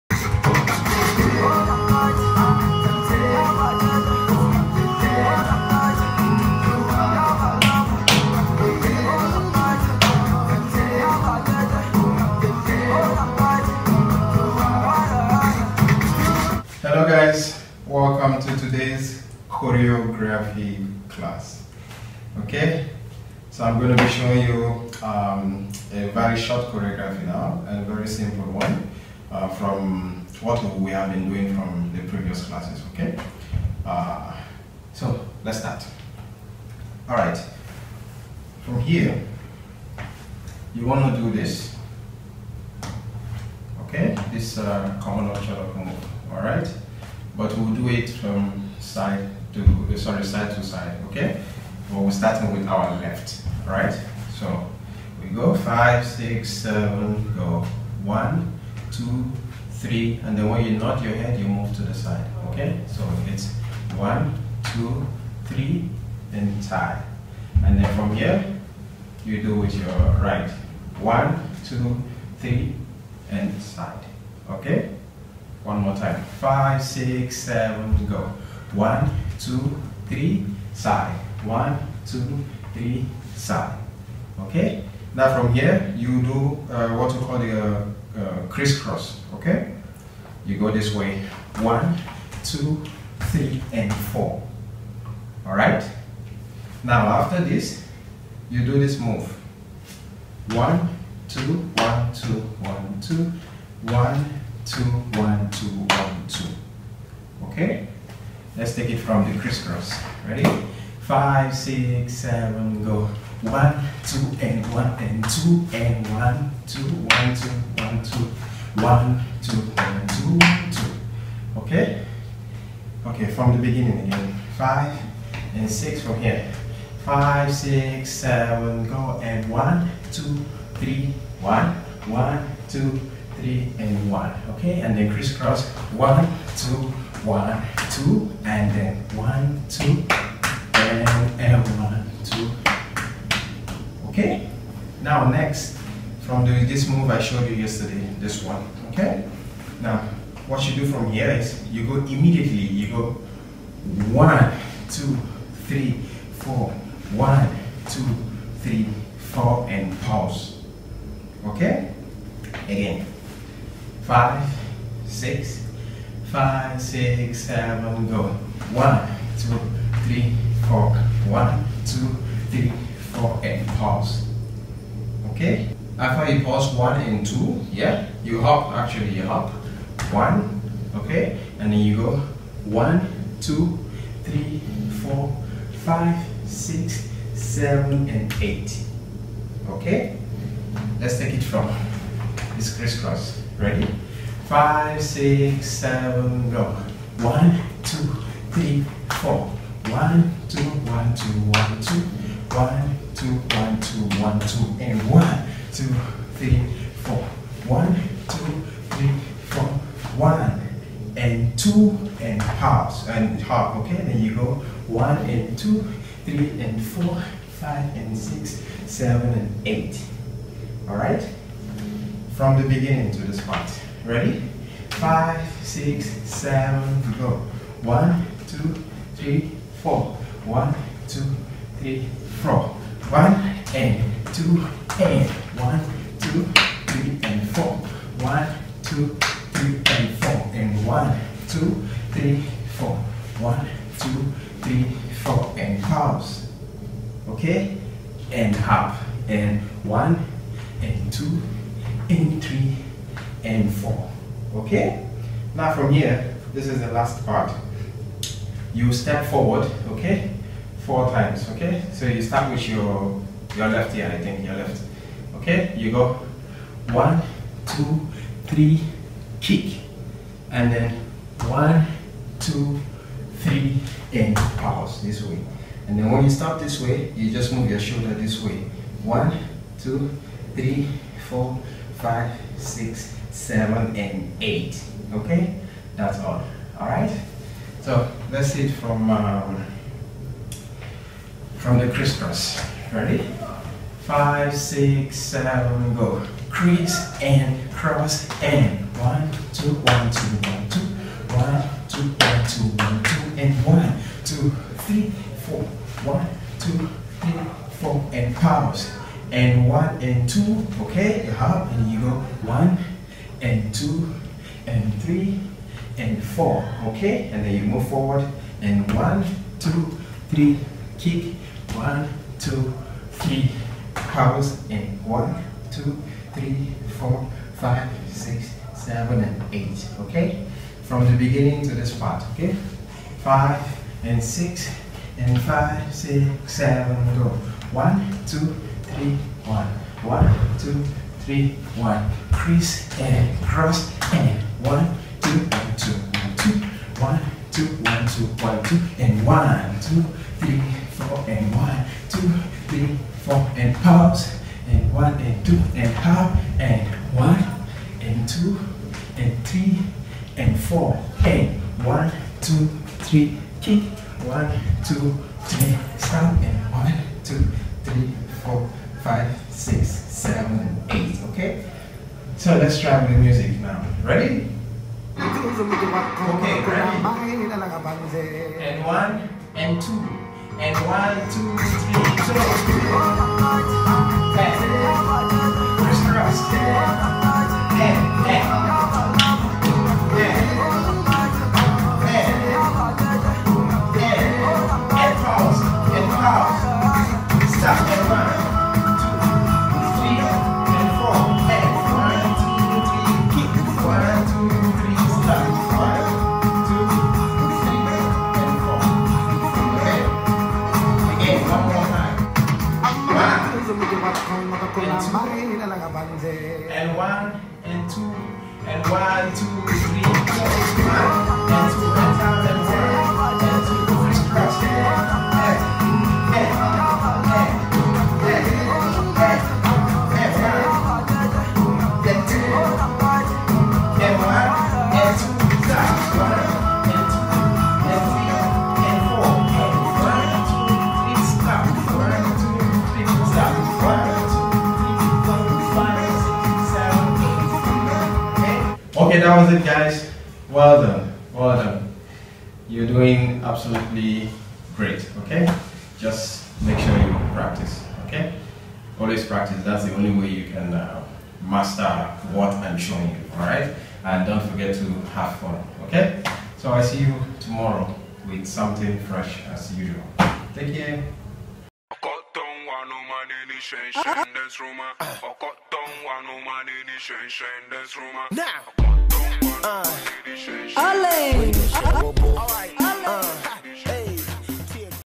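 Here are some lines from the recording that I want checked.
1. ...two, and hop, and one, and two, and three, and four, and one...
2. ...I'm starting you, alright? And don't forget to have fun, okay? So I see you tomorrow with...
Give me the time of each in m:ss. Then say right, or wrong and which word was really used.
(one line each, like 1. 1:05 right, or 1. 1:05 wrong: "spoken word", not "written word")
1. 5:55 right
2. 7:42 wrong: "showing", not "starting".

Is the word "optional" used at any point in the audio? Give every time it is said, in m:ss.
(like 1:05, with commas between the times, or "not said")
0:45.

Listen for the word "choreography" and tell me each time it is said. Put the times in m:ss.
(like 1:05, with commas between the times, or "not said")
0:19, 0:26.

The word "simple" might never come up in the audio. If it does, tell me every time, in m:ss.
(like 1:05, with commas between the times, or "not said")
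0:28.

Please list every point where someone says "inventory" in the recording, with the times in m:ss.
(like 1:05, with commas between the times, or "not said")
not said.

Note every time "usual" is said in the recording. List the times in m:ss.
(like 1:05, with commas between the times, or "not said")
7:49.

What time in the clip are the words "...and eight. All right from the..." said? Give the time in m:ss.
3:39.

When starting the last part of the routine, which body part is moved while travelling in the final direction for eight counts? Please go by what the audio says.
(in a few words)
shoulder.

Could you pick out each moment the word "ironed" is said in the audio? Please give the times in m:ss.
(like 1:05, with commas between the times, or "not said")
not said.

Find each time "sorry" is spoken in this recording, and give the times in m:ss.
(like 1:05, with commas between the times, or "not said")
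0:49.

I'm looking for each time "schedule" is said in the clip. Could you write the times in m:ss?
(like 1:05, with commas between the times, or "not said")
not said.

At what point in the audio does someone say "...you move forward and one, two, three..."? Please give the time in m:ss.
5:17.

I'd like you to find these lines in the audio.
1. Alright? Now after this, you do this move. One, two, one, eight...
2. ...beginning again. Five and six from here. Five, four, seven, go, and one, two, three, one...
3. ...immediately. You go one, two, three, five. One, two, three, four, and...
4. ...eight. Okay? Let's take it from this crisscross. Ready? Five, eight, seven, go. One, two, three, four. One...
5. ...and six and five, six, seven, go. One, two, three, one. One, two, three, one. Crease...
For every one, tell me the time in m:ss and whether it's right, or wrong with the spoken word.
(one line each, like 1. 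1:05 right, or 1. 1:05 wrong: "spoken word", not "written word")
1. 1:35 wrong: "two", not "eight"
2. 2:03 wrong: "six", not "four"
3. 2:31 wrong: "four", not "five"
4. 3:08 wrong: "six", not "eight"
5. 5:34 right.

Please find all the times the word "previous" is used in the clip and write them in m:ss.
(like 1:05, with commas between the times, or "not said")
0:32.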